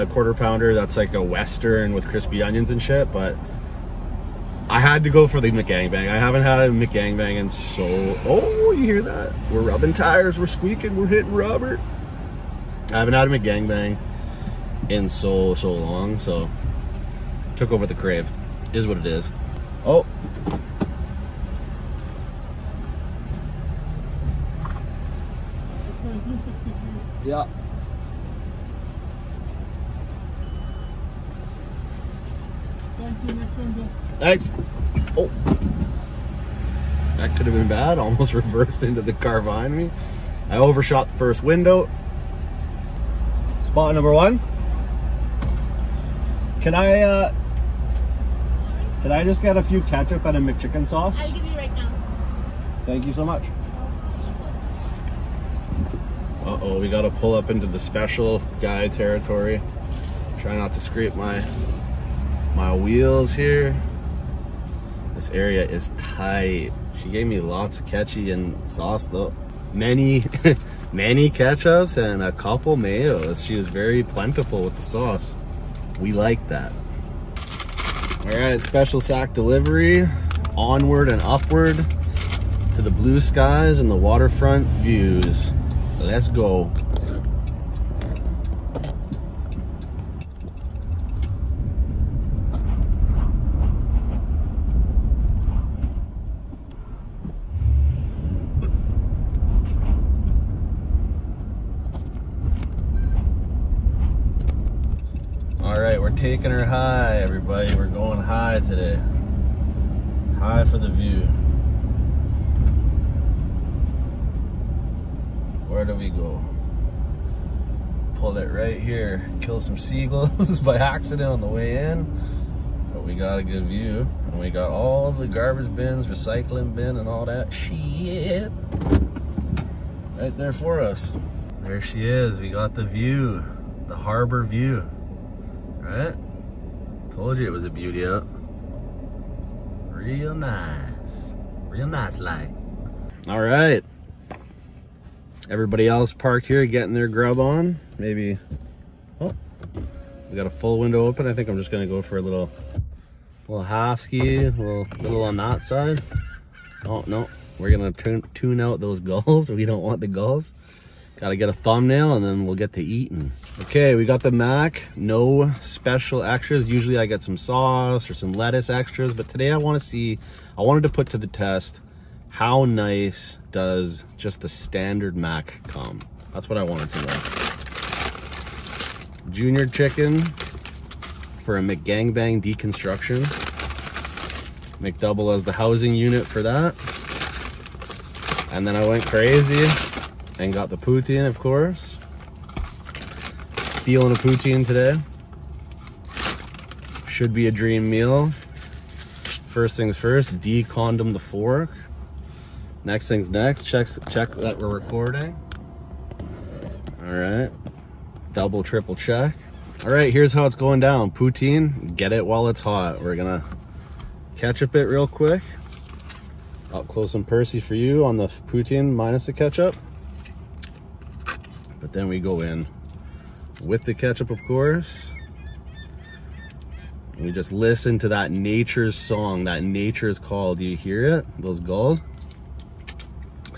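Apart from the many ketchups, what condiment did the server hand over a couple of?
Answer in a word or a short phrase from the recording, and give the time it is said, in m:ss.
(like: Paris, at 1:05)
mayos, at 1:12.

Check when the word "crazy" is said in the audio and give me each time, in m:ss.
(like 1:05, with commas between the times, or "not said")
3:09.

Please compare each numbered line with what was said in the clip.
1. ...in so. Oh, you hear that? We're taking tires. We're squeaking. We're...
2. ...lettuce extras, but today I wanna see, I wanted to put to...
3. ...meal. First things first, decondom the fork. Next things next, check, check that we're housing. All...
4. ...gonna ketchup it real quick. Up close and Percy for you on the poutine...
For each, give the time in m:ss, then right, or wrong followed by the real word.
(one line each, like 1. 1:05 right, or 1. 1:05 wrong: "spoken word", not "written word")
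1. 0:07 wrong: "rubbing", not "taking"
2. 2:48 right
3. 3:17 wrong: "recording", not "housing"
4. 3:33 right.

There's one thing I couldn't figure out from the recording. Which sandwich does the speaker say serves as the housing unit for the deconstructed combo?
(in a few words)
McDouble.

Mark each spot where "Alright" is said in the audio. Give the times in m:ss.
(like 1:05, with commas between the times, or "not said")
2:15, 2:23.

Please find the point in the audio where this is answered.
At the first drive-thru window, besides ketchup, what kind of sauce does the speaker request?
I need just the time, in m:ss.
0:50.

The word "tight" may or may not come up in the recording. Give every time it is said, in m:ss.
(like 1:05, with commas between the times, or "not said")
1:05.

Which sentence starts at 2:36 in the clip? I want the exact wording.
Oh, no, we're gonna tune, tune out those gulls.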